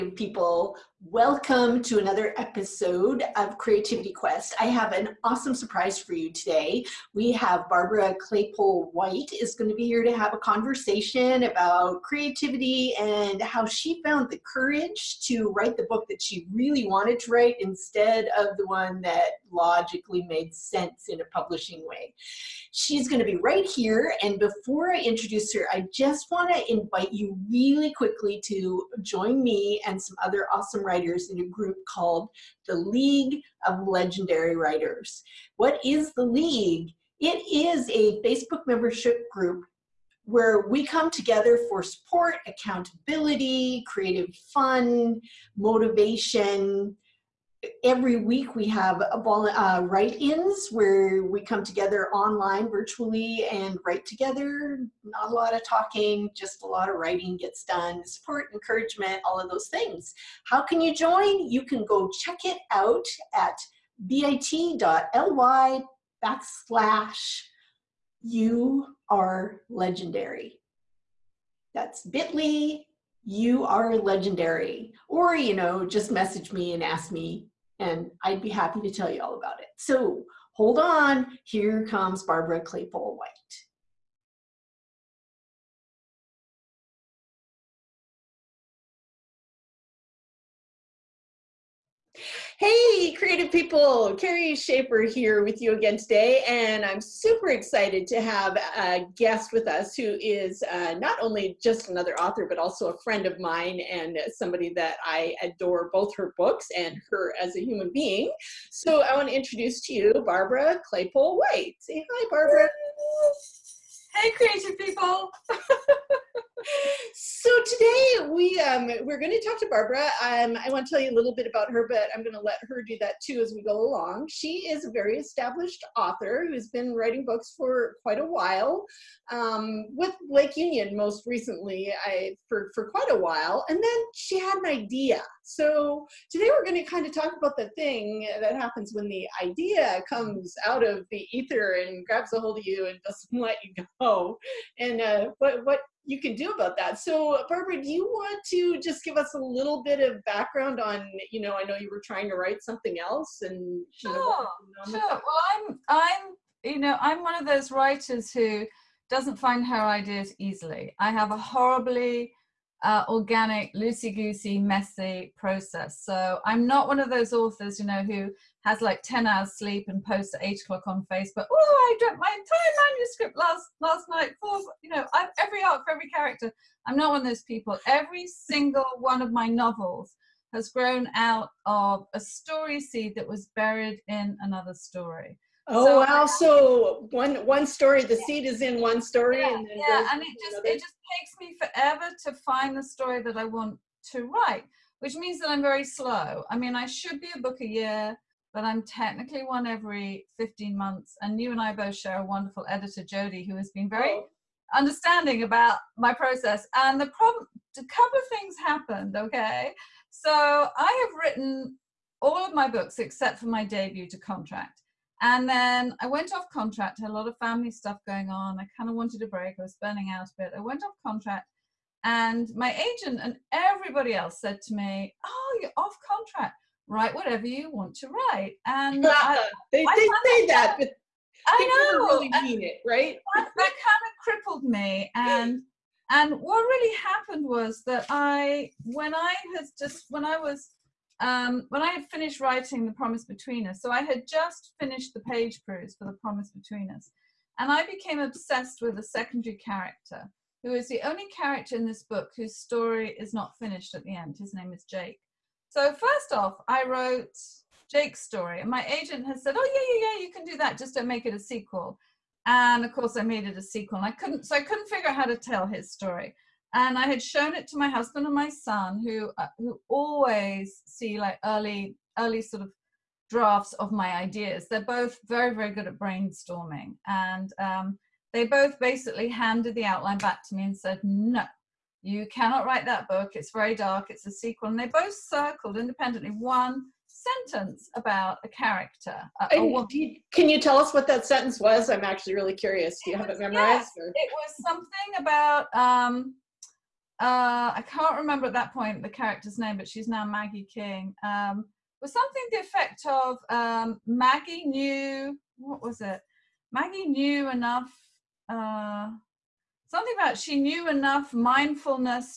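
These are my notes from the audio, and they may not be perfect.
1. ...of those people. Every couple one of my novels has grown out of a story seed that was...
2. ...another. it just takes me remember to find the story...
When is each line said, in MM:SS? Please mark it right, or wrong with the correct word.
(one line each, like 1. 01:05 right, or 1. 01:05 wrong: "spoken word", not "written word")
1. 02:57 wrong: "single", not "couple"
2. 03:10 wrong: "forever", not "remember".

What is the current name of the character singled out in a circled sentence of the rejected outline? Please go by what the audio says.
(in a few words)
Maggie King.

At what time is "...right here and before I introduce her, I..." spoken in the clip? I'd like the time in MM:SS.
00:23.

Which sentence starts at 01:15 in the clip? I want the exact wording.
Or, you know, just message me and ask me, and I'd be happy to tell you all about it.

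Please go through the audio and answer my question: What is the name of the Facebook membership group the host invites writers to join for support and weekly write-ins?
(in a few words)
League of Legendary Writers.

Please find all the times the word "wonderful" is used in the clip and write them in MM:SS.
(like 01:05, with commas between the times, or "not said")
03:22.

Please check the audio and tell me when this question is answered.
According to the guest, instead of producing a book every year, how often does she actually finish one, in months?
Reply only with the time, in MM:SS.
03:20.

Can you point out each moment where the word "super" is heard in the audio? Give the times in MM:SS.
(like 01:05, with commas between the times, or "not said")
01:36.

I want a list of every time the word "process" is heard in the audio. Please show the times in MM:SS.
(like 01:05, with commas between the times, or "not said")
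02:45, 03:26.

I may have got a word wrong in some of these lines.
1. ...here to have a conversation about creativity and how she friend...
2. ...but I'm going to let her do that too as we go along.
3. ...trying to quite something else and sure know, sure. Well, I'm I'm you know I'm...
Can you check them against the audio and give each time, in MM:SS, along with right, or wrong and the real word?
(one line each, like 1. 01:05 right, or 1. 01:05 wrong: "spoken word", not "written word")
1. 00:09 wrong: "found", not "friend"
2. 02:01 right
3. 02:32 wrong: "write", not "quite".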